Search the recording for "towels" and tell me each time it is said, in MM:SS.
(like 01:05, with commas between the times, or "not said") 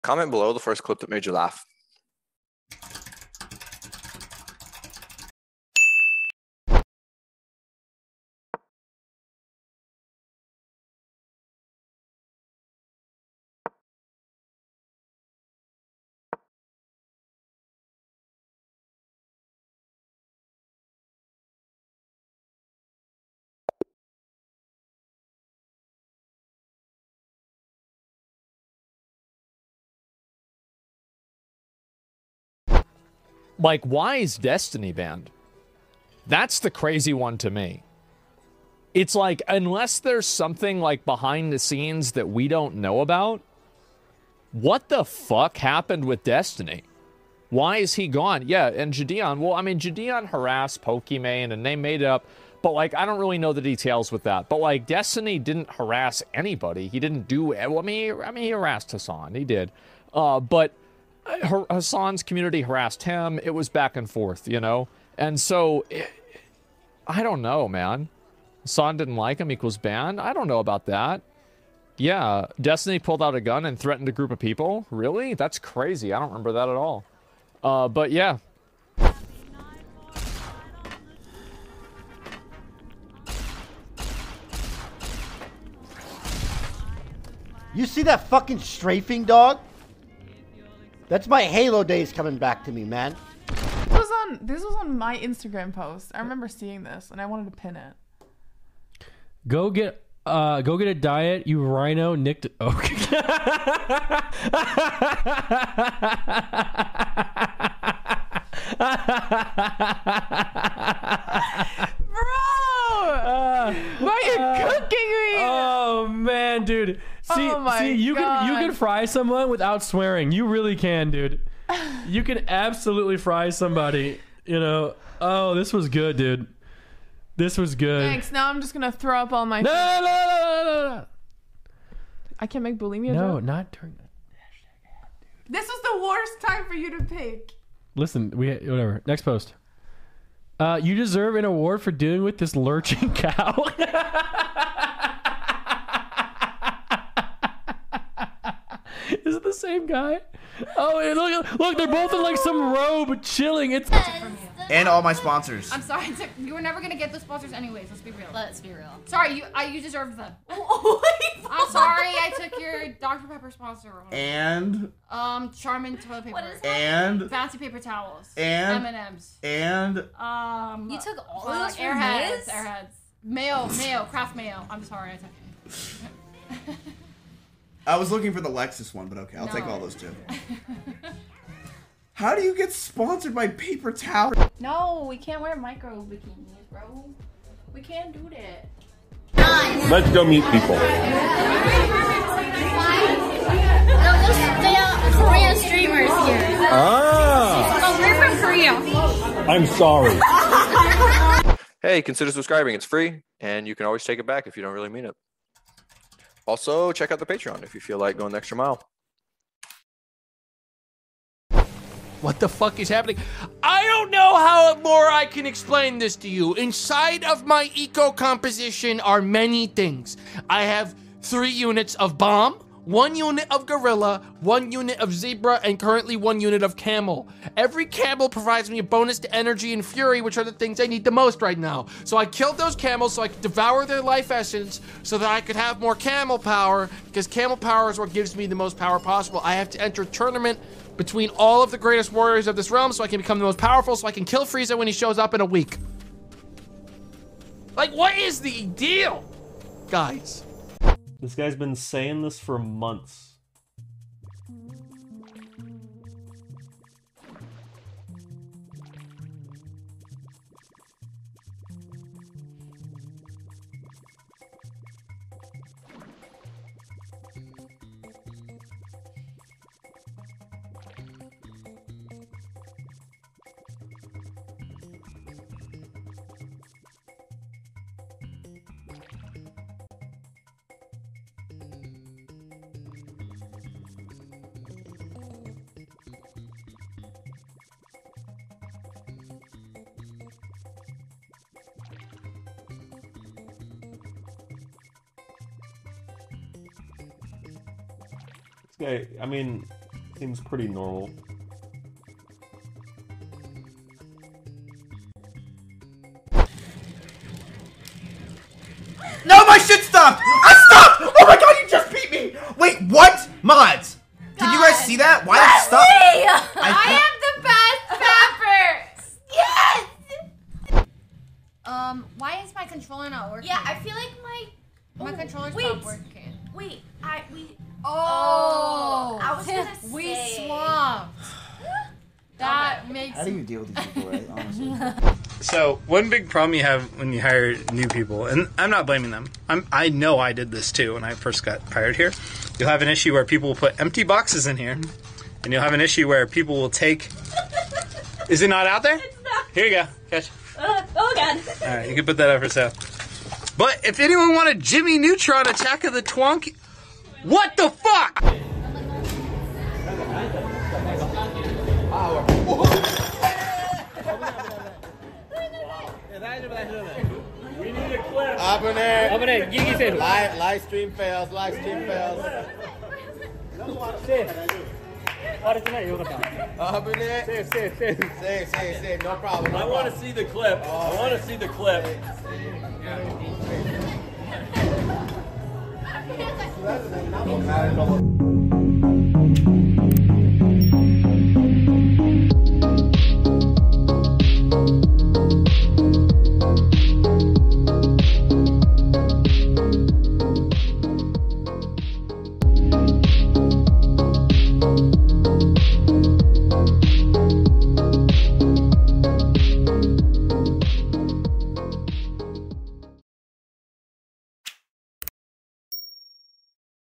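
02:47, 03:03.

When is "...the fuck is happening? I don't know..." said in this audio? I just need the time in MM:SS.
03:32.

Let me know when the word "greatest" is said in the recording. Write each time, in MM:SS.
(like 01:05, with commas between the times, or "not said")
04:01.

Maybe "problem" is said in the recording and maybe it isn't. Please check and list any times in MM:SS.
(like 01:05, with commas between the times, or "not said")
05:36, 06:19.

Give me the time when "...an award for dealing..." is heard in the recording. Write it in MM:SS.
02:21.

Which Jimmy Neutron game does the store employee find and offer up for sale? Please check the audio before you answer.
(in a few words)
Attack of the Twonk.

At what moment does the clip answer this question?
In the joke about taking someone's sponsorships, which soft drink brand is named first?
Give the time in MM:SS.
02:42.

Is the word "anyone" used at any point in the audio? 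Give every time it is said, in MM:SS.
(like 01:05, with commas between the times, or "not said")
05:53.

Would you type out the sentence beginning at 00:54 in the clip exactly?
But like, Destiny didn't harass anybody.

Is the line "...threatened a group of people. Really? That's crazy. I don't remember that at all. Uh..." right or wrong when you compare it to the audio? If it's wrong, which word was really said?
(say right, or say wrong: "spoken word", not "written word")
right.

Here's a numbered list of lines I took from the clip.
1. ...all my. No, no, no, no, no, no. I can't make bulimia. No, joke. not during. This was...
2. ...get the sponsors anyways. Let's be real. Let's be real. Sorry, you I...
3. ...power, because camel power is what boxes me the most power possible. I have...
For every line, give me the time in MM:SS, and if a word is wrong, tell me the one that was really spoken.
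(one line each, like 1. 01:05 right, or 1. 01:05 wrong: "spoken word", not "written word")
1. 02:09 right
2. 02:36 right
3. 03:56 wrong: "gives", not "boxes".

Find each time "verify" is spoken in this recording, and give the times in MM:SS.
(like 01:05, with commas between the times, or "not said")
not said.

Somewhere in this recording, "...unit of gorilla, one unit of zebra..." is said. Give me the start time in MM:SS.
03:43.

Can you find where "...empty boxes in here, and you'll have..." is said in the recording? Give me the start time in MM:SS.
05:43.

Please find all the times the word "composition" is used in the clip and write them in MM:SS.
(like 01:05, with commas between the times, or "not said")
03:38.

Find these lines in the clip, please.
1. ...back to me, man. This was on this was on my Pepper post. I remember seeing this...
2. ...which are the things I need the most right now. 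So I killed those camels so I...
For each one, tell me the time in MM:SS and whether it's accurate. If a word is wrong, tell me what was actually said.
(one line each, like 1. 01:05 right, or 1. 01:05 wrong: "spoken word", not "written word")
1. 01:32 wrong: "Instagram", not "Pepper"
2. 03:50 right.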